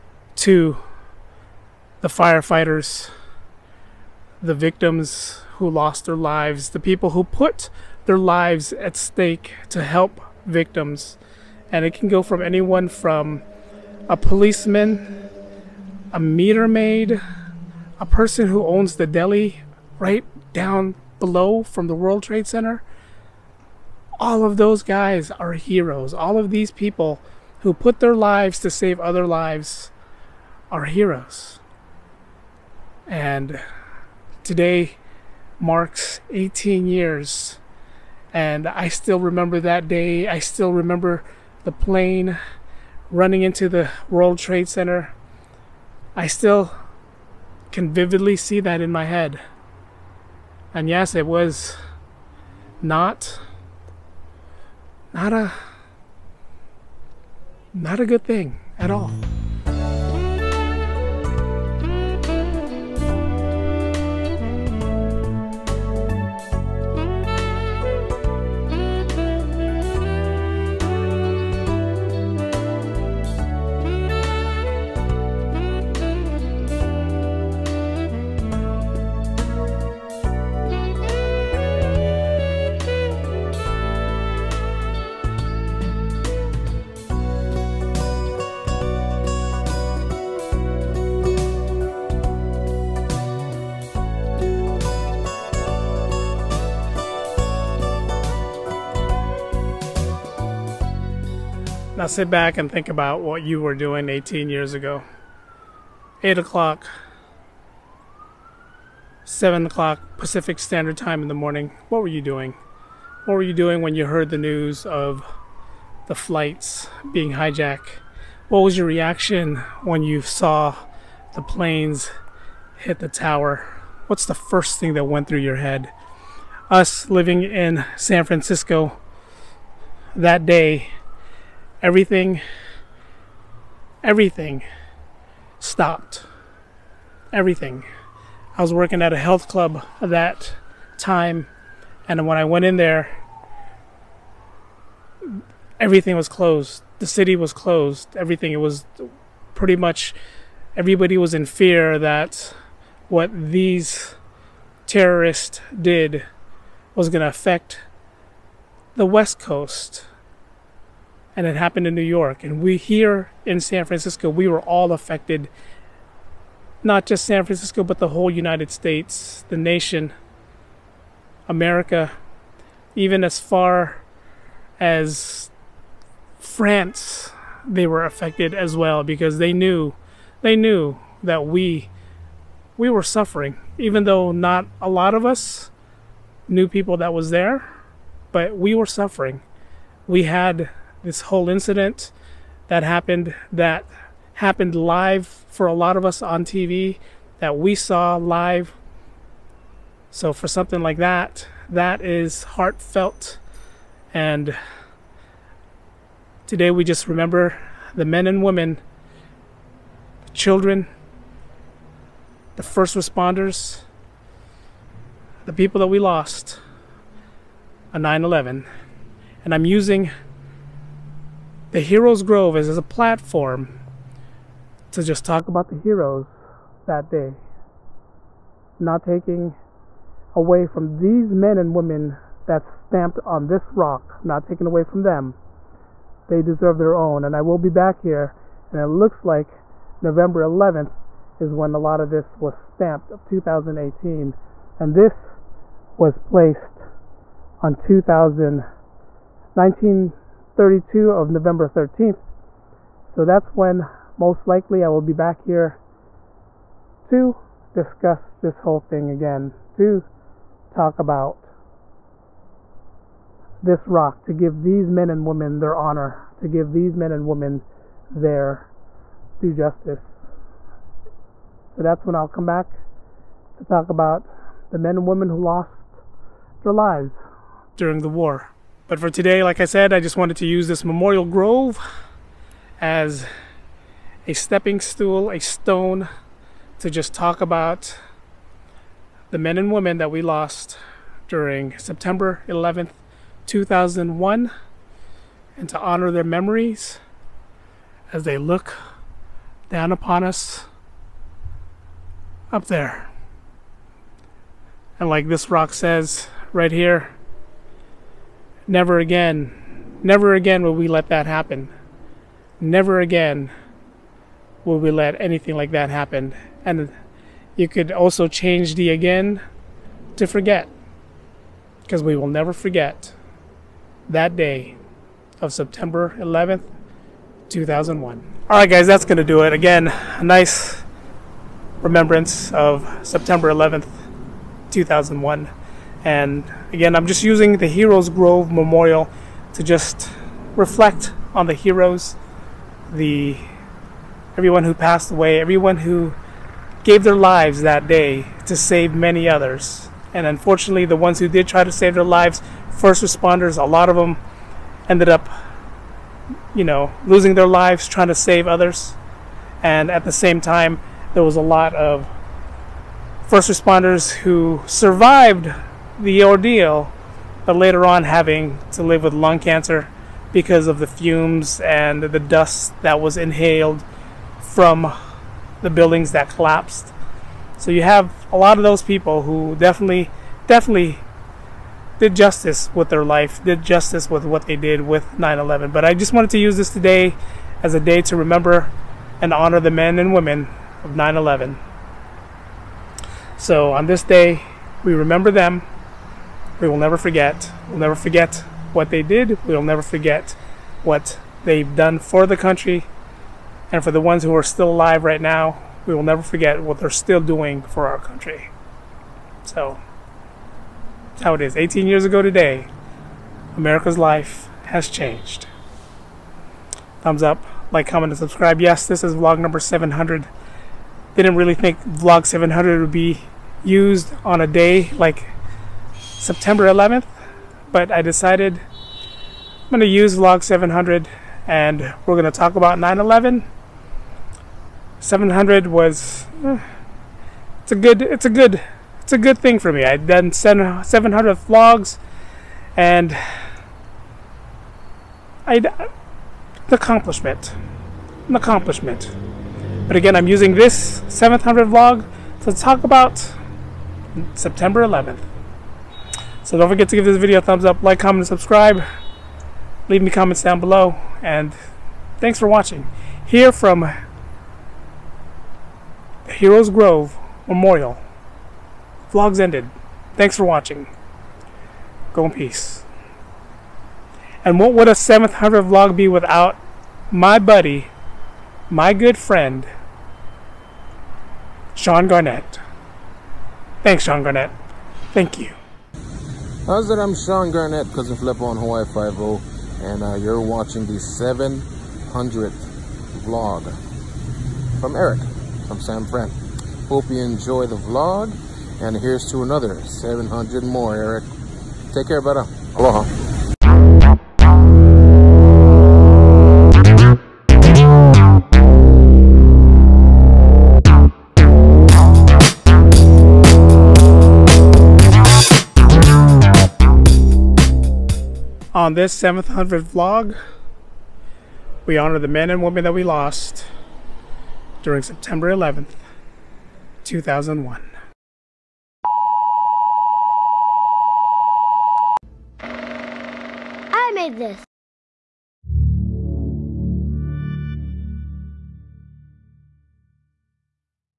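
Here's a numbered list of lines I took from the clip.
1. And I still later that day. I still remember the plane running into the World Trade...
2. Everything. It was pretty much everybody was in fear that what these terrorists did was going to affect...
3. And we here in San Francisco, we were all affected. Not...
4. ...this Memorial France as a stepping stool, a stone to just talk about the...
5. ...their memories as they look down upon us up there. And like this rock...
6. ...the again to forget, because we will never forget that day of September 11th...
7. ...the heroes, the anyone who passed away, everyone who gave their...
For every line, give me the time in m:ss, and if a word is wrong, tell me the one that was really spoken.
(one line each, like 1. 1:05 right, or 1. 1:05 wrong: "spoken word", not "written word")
1. 0:38 wrong: "remember", not "later"
2. 2:28 right
3. 2:42 right
4. 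4:40 wrong: "Grove", not "France"
5. 4:56 right
6. 5:18 right
7. 5:41 wrong: "everyone", not "anyone".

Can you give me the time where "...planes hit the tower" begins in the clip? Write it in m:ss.
2:01.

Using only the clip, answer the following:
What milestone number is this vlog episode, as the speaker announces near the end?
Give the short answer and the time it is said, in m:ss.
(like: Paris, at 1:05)
700, at 6:59.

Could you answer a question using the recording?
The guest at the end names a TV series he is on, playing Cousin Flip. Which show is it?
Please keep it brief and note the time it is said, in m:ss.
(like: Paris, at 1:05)
Hawaii Five-0, at 8:08.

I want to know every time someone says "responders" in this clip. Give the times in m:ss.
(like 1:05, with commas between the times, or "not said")
3:32, 5:53, 6:03.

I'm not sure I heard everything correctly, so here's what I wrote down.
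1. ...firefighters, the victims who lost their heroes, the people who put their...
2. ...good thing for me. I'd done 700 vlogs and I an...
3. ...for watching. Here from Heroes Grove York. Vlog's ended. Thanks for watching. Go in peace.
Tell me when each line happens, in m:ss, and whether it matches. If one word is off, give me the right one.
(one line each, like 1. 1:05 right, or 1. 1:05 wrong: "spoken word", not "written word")
1. 0:02 wrong: "lives", not "heroes"
2. 7:19 right
3. 7:42 wrong: "Memorial", not "York".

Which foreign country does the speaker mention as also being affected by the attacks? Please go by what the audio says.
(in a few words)
France.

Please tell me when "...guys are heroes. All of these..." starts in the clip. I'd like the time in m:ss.
0:24.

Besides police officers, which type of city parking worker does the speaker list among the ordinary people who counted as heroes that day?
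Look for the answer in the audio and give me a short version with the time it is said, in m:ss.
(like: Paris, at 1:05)
meter maid, at 0:16.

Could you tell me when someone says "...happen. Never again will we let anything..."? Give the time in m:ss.
5:11.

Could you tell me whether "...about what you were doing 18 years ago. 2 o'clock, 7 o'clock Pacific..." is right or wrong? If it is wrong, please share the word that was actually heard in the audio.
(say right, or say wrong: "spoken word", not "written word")
wrong: "8", not "2".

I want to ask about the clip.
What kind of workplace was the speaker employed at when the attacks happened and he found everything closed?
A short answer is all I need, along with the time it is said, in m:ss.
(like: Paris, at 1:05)
health club, at 2:19.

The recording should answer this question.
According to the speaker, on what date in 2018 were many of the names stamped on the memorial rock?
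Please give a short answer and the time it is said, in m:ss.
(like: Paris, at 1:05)
November 11th, at 3:59.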